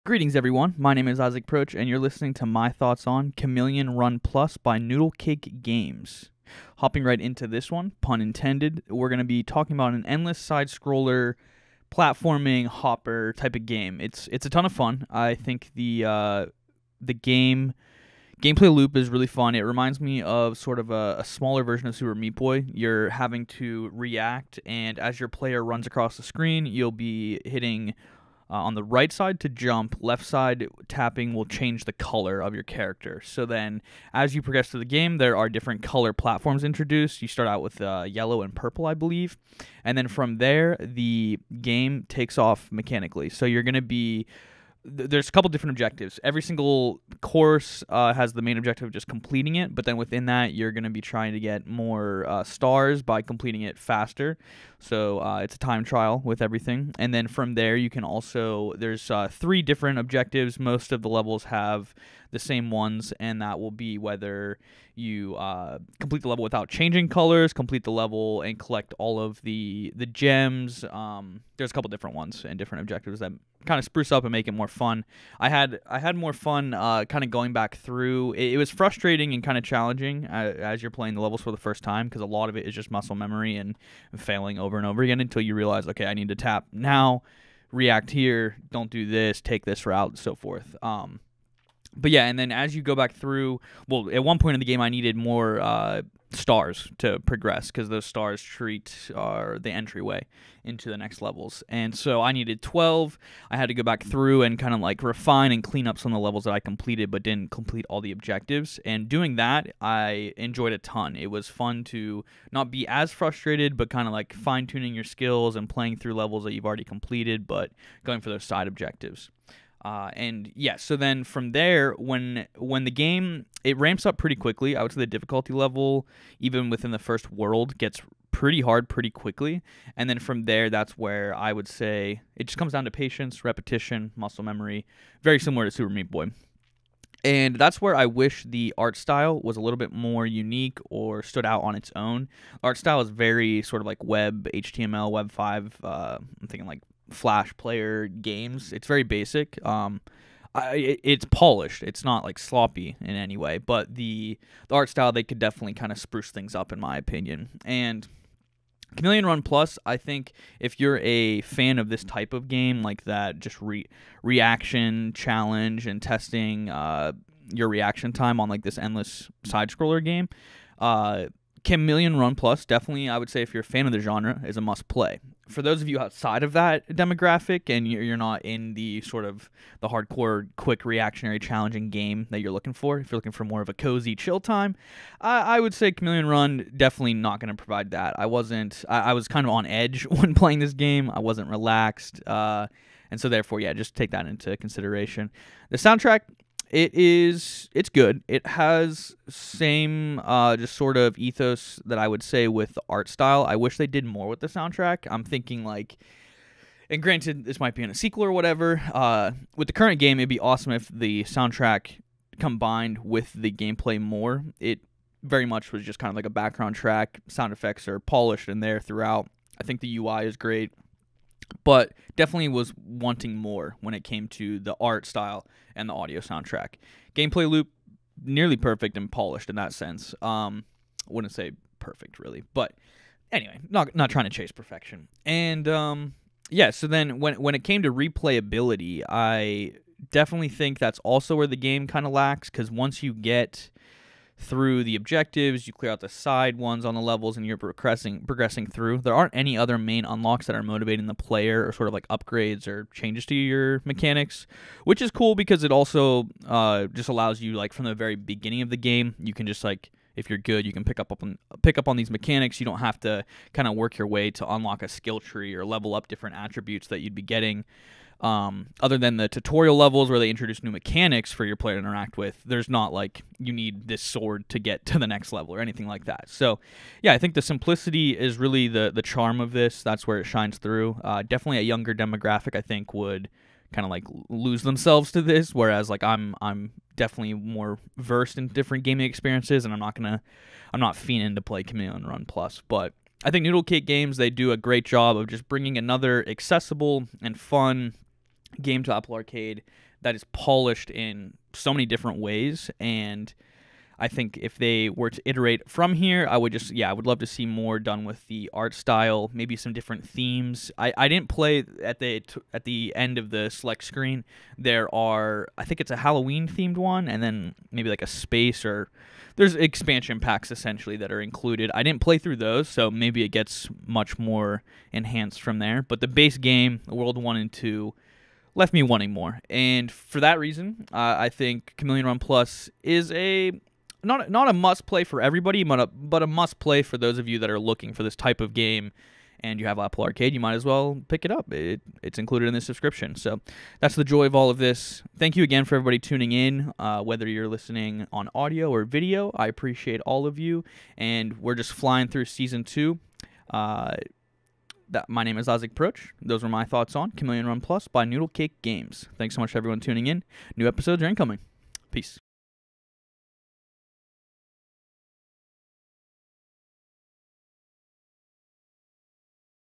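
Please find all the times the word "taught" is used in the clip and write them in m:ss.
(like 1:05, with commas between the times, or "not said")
not said.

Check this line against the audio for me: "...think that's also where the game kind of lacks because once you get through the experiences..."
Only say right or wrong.
wrong.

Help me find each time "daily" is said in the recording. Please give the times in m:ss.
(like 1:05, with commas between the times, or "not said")
not said.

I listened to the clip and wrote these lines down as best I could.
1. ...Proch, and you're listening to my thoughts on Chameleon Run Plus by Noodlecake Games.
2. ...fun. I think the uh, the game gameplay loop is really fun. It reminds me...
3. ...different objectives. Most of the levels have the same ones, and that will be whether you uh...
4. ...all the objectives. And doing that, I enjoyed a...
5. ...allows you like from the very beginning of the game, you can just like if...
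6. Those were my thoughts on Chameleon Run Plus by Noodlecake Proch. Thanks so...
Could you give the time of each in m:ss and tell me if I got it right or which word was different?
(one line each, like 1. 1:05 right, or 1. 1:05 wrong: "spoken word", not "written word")
1. 0:01 right
2. 0:14 right
3. 0:59 right
4. 1:47 right
5. 4:17 right
6. 5:56 wrong: "Games", not "Proch".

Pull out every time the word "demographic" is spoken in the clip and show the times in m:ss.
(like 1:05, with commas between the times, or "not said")
2:56, 4:41.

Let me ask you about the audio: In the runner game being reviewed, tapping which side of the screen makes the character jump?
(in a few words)
Right side.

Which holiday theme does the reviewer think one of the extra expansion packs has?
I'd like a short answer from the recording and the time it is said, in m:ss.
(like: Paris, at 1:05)
Halloween, at 5:15.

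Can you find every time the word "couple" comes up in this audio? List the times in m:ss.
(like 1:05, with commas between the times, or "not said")
0:45, 1:11.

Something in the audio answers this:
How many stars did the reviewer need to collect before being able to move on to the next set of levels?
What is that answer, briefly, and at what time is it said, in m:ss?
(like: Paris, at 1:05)
12, at 1:42.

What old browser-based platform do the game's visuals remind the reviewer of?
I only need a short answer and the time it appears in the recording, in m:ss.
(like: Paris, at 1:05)
Flash player, at 2:27.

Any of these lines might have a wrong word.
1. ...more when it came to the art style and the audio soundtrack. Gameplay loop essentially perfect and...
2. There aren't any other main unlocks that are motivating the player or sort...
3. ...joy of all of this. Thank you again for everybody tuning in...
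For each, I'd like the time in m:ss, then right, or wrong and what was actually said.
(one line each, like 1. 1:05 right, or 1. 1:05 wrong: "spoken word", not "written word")
1. 3:43 wrong: "nearly", not "essentially"
2. 4:08 right
3. 5:44 right.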